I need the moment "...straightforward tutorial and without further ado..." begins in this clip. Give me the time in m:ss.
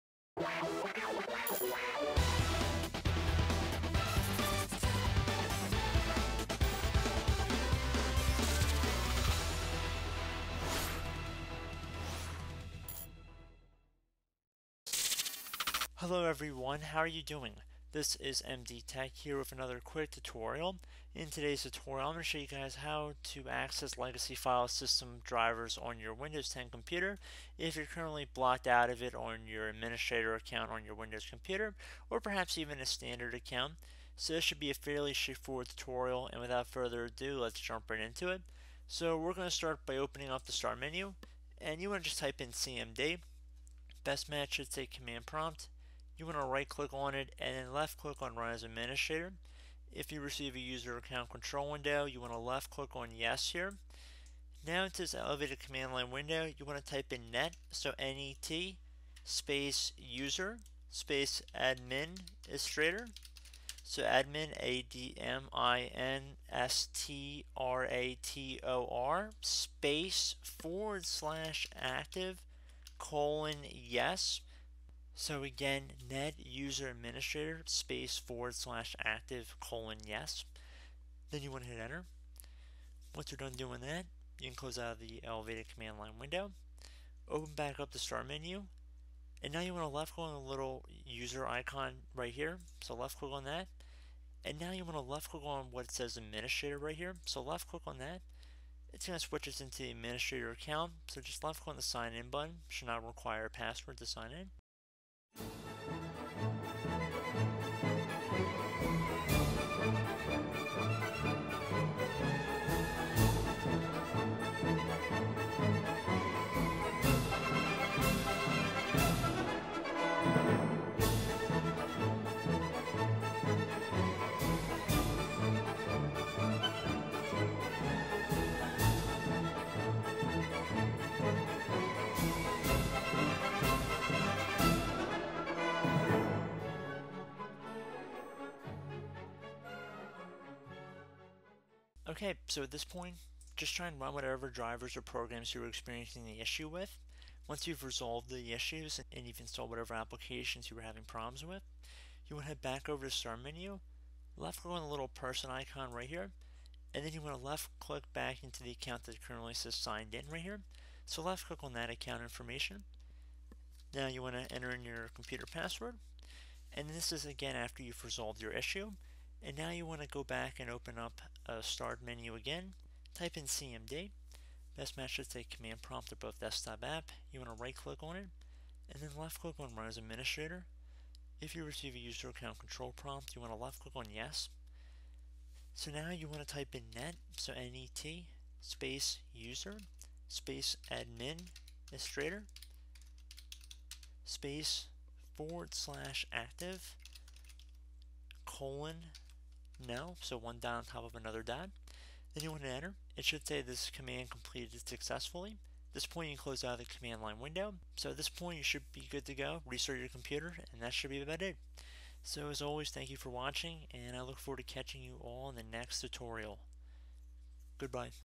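0:35.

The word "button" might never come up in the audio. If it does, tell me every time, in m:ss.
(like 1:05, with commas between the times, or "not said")
1:42.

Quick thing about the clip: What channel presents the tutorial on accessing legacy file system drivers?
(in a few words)
MD Tech.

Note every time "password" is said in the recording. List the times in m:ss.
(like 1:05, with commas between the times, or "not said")
1:43, 2:45.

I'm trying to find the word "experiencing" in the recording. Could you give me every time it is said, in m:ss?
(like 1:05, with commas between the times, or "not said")
2:25.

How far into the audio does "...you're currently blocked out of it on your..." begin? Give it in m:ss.
0:27.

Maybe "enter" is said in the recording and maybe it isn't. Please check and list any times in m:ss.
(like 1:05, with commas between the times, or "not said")
1:21, 2:44, 3:22.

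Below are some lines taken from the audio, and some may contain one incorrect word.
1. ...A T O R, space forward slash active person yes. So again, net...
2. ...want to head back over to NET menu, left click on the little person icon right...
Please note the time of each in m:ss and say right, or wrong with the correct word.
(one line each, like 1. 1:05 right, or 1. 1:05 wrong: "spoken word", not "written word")
1. 1:07 wrong: "colon", not "person"
2. 2:32 wrong: "Start", not "NET".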